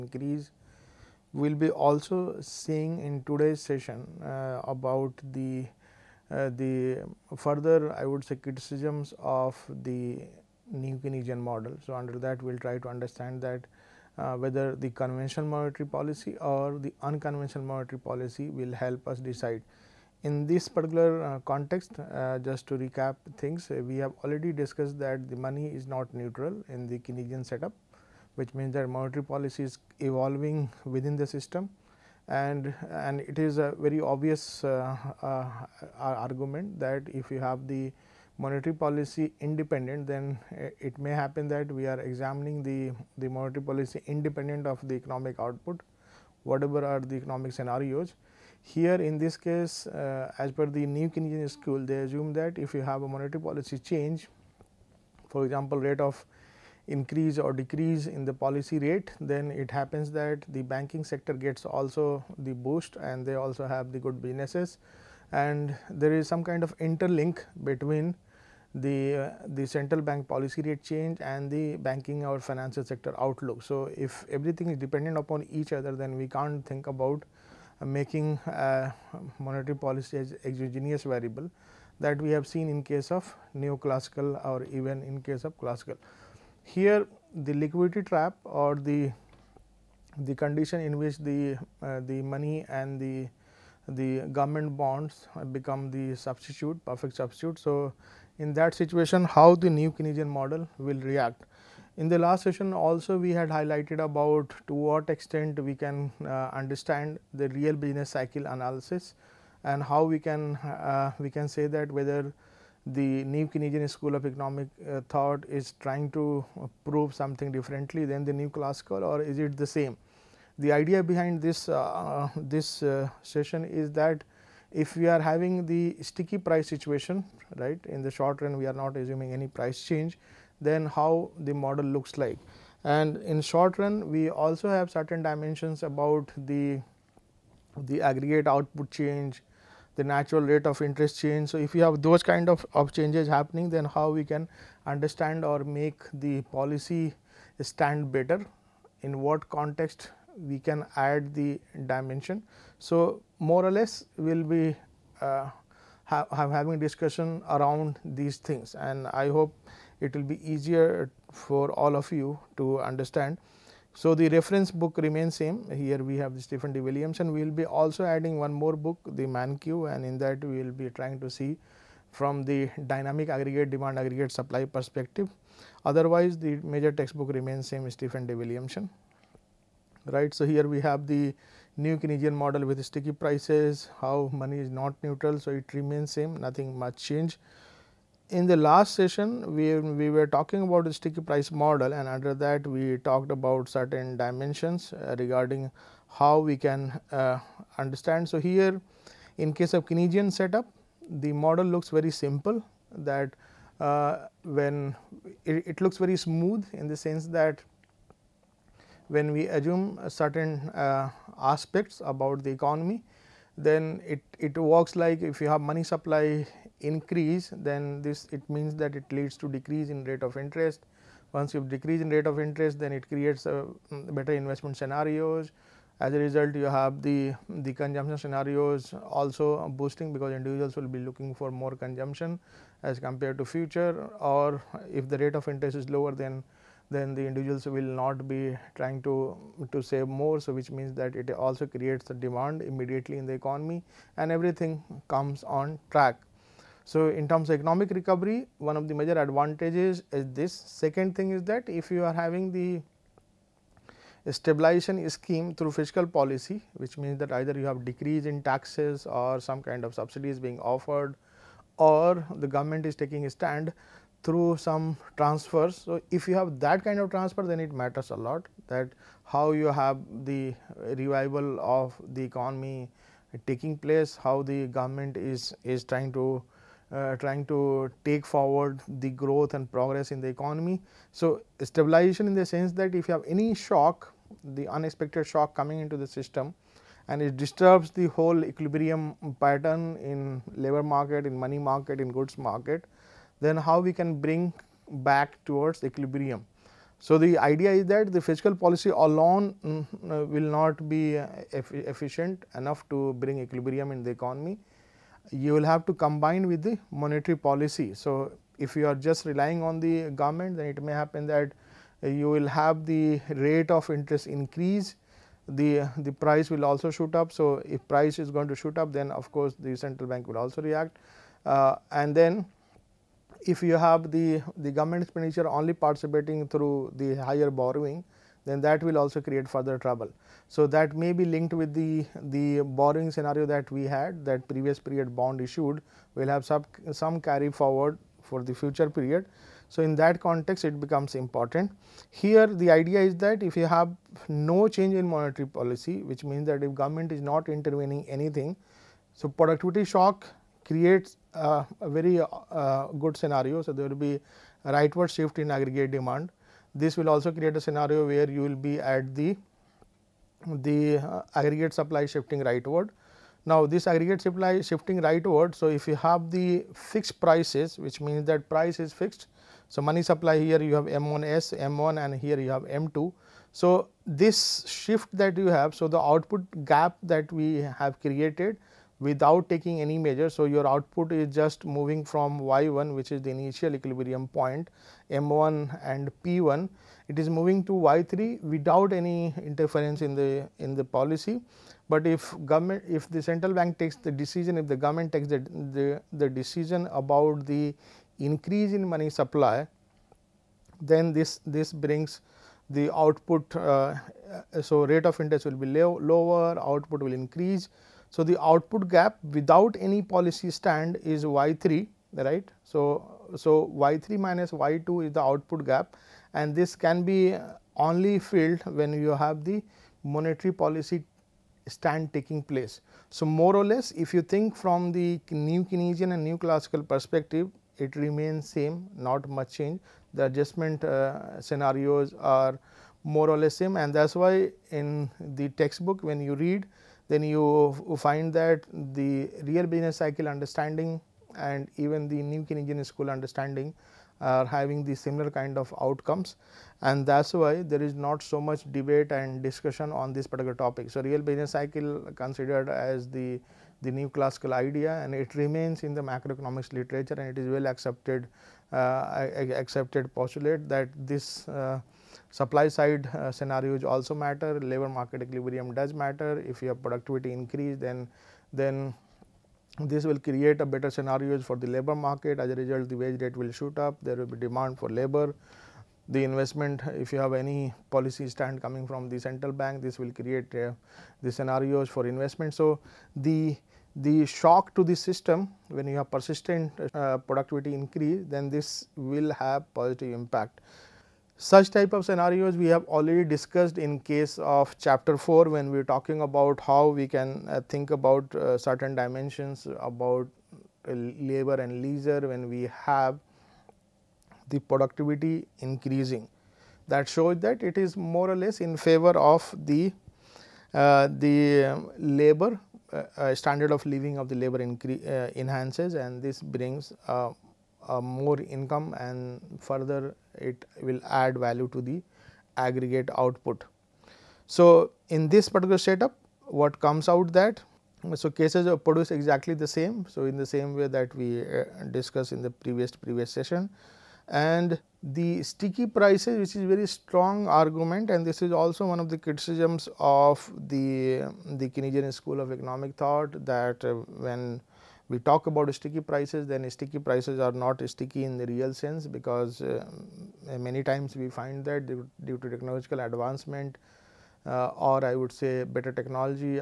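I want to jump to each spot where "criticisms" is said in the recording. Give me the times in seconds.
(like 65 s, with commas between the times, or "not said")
8 s, 539 s.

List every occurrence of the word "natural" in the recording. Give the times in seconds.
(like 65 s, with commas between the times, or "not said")
140 s.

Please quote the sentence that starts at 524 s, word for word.
So, in this particular setup what comes out that so cases are produced exactly the same.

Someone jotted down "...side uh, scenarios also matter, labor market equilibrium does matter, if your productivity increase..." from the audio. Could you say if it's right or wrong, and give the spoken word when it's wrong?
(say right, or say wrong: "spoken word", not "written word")
right.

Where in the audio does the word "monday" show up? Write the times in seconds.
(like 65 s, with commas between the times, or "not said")
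not said.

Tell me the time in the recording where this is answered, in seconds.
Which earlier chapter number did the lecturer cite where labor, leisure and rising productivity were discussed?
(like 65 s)
494 s.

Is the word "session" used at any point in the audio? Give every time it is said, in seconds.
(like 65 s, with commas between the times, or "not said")
3 s, 102 s, 123 s, 188 s, 533 s.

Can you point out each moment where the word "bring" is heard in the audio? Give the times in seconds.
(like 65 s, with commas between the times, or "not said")
294 s, 303 s, 401 s, 516 s.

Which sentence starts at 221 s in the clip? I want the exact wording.
Once you decrease in rate of interest, then it creates a uh, better investment scenarios.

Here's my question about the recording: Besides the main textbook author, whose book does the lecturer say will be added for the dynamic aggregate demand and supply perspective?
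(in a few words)
Mankiw.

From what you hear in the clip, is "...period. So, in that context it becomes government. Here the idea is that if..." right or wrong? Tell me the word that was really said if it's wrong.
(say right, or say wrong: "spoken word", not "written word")
wrong: "important", not "government".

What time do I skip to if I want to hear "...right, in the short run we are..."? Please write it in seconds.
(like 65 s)
127 s.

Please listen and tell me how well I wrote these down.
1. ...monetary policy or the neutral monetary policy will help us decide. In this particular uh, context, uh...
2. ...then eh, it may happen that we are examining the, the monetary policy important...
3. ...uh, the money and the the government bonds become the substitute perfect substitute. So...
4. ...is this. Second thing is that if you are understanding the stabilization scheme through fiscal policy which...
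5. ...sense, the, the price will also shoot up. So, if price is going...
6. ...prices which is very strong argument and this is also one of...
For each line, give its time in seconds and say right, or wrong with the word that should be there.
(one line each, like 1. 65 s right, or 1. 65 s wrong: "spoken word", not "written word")
1. 15 s wrong: "unconventional", not "neutral"
2. 40 s wrong: "independent", not "important"
3. 91 s right
4. 250 s wrong: "having", not "understanding"
5. 314 s wrong: "increase", not "sense"
6. 535 s right.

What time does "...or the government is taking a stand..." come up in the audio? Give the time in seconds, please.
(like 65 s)
261 s.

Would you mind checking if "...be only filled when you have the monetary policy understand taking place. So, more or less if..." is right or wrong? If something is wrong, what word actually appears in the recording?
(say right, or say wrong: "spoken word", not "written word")
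wrong: "stand", not "understand".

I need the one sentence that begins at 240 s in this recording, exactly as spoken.
So, which means that it also creates the demand immediately in the economy and everything comes on track.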